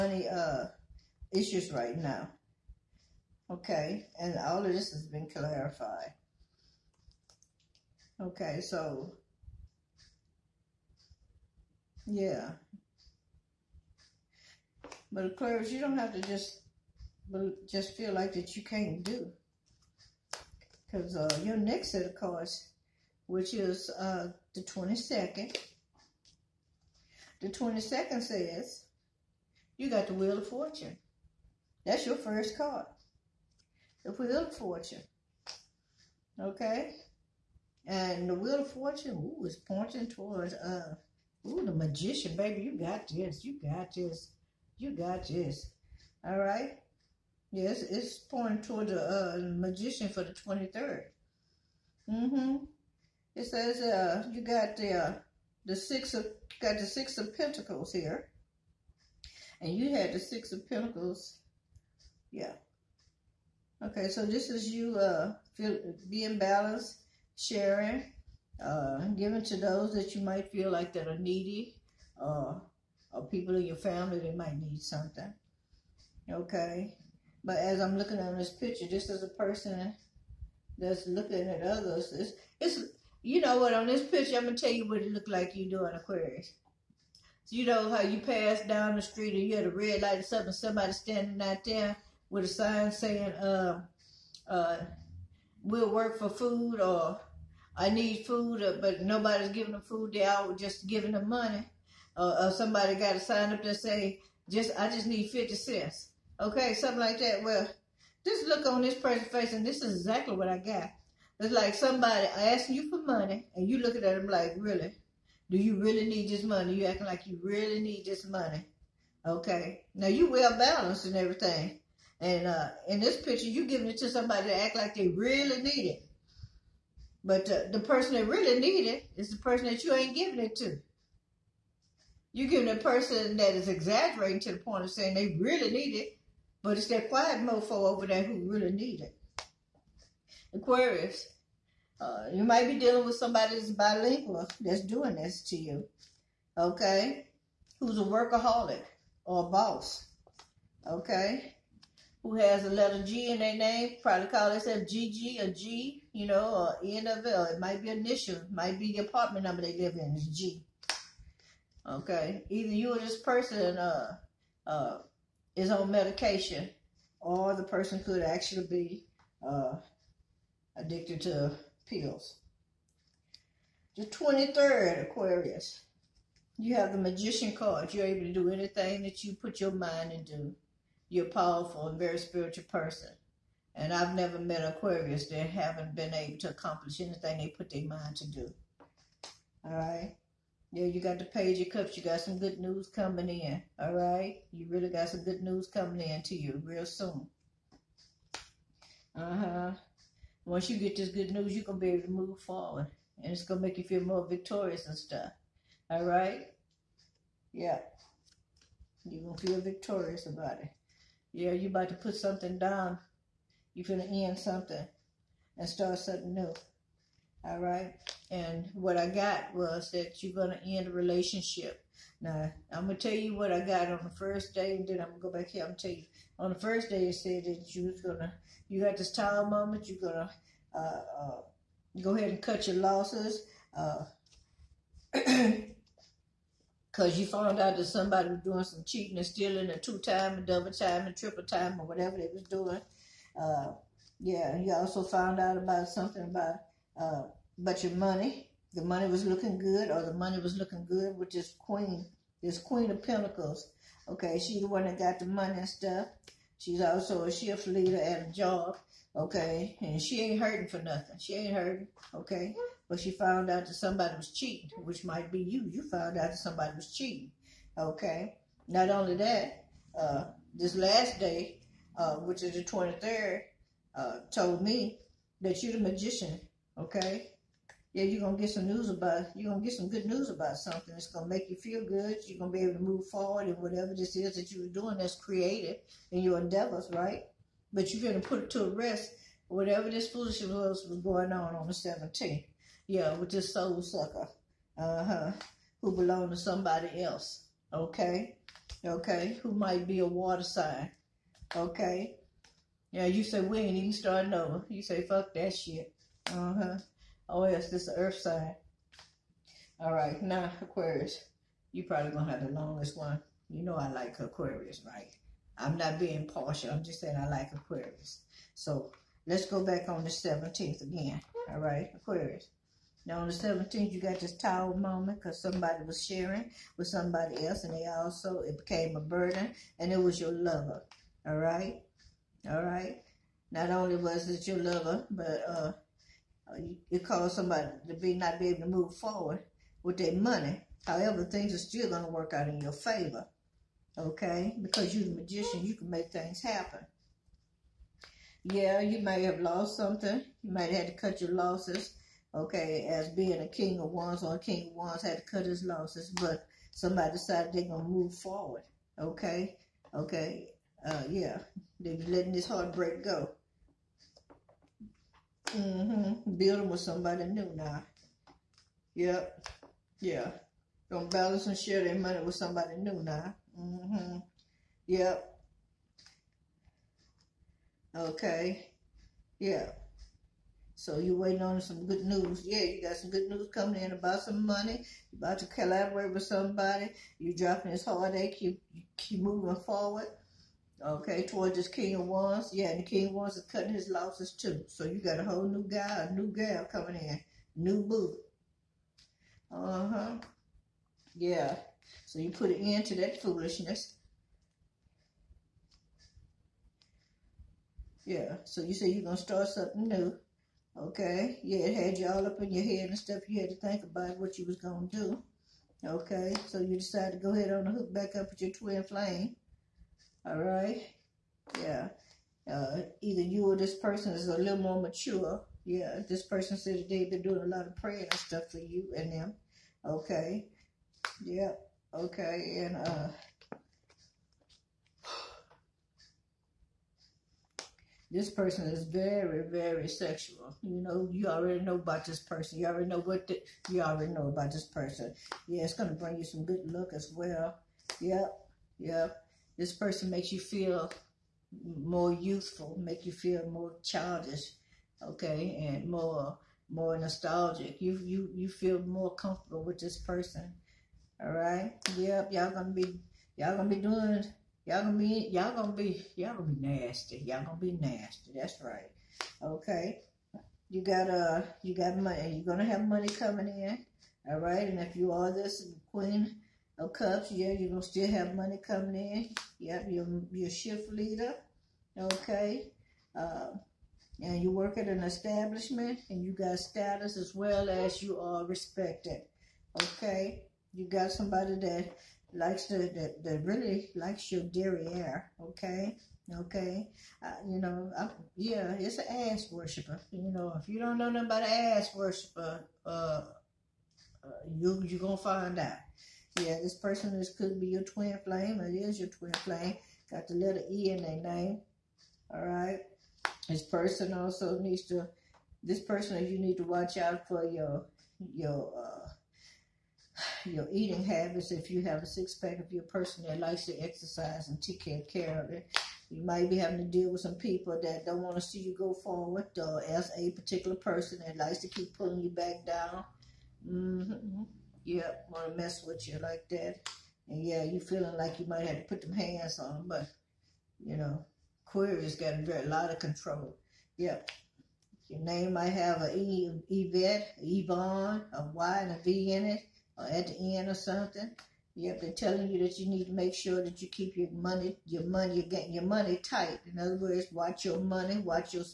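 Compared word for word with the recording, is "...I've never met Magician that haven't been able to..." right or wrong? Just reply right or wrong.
wrong.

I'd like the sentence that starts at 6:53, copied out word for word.
You had to think about what you was going to do.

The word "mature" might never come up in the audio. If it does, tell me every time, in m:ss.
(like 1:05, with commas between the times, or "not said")
7:04.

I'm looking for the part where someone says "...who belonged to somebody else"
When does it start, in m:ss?
4:55.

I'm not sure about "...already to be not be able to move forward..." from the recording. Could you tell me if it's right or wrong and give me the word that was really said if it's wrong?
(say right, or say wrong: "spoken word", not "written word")
wrong: "somebody", not "already".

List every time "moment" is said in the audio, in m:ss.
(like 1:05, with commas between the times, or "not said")
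3:49, 5:24.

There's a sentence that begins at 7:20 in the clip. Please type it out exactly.
You know, you already know about this person.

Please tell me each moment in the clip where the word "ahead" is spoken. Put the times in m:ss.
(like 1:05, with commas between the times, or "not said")
3:52, 6:57.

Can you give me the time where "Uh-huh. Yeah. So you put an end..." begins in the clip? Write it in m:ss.
6:39.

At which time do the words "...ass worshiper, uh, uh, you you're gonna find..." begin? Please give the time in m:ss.
8:21.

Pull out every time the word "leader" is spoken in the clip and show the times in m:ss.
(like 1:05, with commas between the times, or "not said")
4:17, 8:00.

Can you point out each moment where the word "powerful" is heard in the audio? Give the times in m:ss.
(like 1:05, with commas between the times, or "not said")
3:01.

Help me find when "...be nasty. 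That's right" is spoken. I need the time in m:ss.
7:47.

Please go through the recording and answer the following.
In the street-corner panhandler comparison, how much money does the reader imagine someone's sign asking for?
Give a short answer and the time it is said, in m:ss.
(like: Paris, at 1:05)
50 cents, at 1:45.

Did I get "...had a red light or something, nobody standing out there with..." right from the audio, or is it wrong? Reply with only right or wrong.
wrong.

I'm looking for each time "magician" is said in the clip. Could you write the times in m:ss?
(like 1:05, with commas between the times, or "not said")
0:41, 0:49, 2:56, 4:35, 5:45.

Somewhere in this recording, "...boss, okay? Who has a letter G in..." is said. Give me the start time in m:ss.
2:29.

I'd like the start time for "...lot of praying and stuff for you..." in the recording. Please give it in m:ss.
7:07.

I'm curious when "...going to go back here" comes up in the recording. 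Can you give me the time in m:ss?
3:45.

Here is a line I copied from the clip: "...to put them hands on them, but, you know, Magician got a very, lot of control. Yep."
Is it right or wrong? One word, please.
wrong.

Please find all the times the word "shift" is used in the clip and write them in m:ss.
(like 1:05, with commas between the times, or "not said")
4:17, 8:00.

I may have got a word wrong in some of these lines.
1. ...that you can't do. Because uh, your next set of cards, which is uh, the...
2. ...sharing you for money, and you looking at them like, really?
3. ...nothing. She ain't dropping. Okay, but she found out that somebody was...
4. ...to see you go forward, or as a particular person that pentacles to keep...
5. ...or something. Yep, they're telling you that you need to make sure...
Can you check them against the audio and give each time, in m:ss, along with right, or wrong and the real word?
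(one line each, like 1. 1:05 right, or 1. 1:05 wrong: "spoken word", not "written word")
1. 0:18 right
2. 1:52 wrong: "asking", not "sharing"
3. 4:20 wrong: "hurting", not "dropping"
4. 8:48 wrong: "likes", not "pentacles"
5. 9:10 right.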